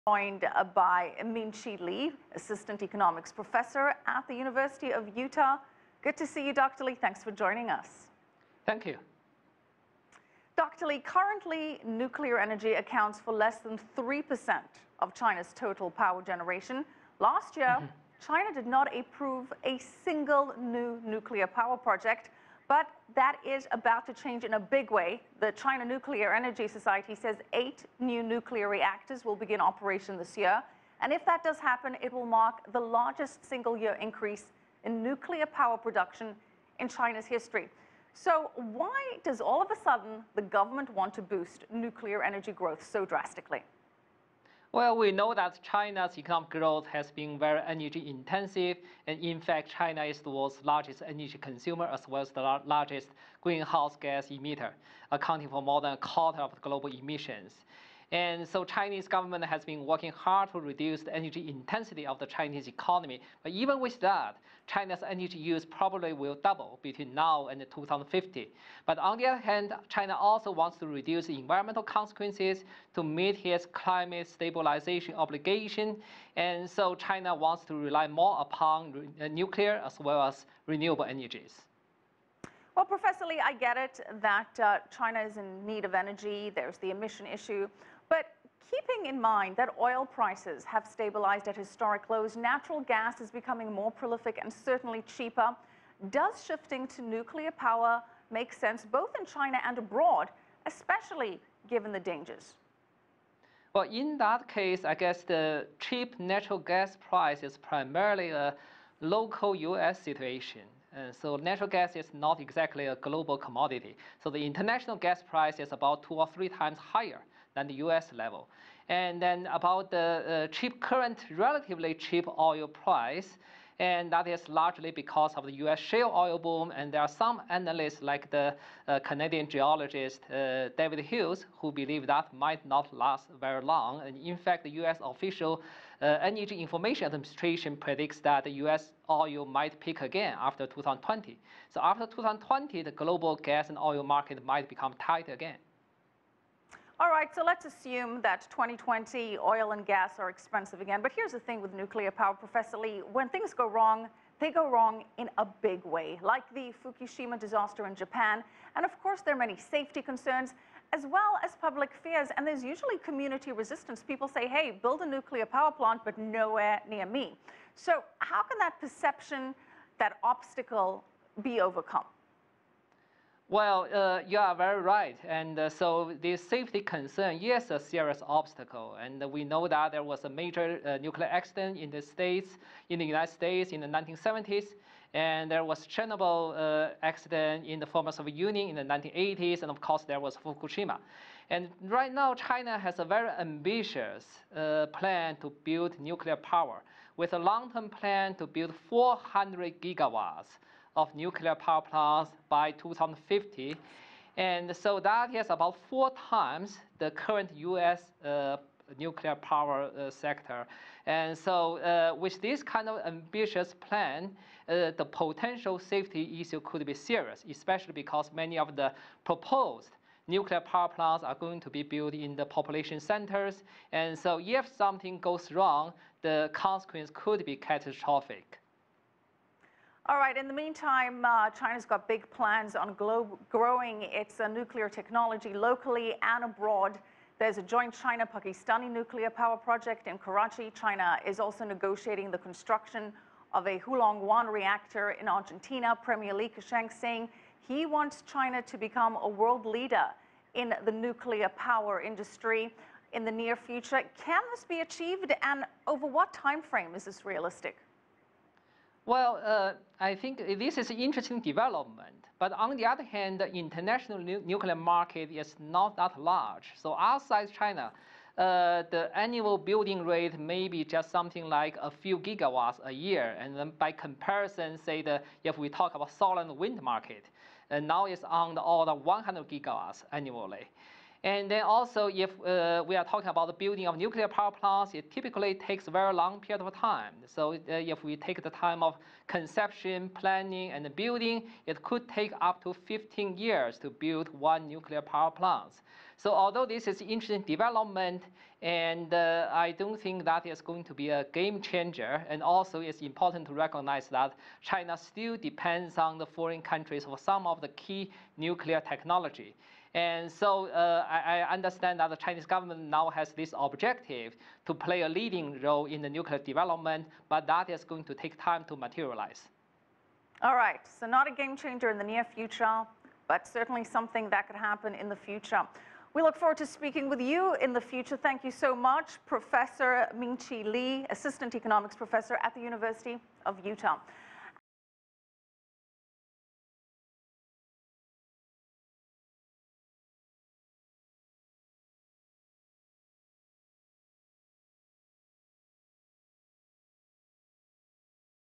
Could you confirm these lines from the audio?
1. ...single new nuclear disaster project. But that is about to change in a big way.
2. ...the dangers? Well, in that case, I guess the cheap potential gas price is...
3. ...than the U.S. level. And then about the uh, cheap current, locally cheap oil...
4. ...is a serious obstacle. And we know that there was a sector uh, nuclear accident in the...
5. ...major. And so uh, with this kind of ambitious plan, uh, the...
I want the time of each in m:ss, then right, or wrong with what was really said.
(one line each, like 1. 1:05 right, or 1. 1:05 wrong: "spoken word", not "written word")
1. 0:20 wrong: "power", not "disaster"
2. 1:41 wrong: "natural", not "potential"
3. 1:57 wrong: "relatively", not "locally"
4. 2:57 wrong: "major", not "sector"
5. 3:30 wrong: "sector", not "major".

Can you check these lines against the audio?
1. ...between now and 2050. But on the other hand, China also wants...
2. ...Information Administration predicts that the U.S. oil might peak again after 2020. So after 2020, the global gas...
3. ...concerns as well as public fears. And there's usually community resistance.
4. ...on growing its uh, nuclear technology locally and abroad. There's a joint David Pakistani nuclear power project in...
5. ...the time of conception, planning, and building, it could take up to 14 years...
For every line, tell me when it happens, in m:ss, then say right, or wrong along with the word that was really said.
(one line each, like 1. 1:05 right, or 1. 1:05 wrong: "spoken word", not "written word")
1. 1:06 right
2. 2:16 right
3. 2:40 right
4. 3:52 wrong: "China", not "David"
5. 4:48 wrong: "15", not "14".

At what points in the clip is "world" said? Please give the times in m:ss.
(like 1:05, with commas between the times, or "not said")
0:50, 4:09.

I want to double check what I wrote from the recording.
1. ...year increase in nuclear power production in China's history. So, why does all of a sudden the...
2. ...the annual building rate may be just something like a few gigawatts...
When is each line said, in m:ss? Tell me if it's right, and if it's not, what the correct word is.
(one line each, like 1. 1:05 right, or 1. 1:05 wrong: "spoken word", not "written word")
1. 0:33 right
2. 4:28 right.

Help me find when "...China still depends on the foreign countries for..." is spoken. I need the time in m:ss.
5:04.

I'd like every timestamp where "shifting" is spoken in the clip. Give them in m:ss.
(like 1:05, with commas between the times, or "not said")
1:36.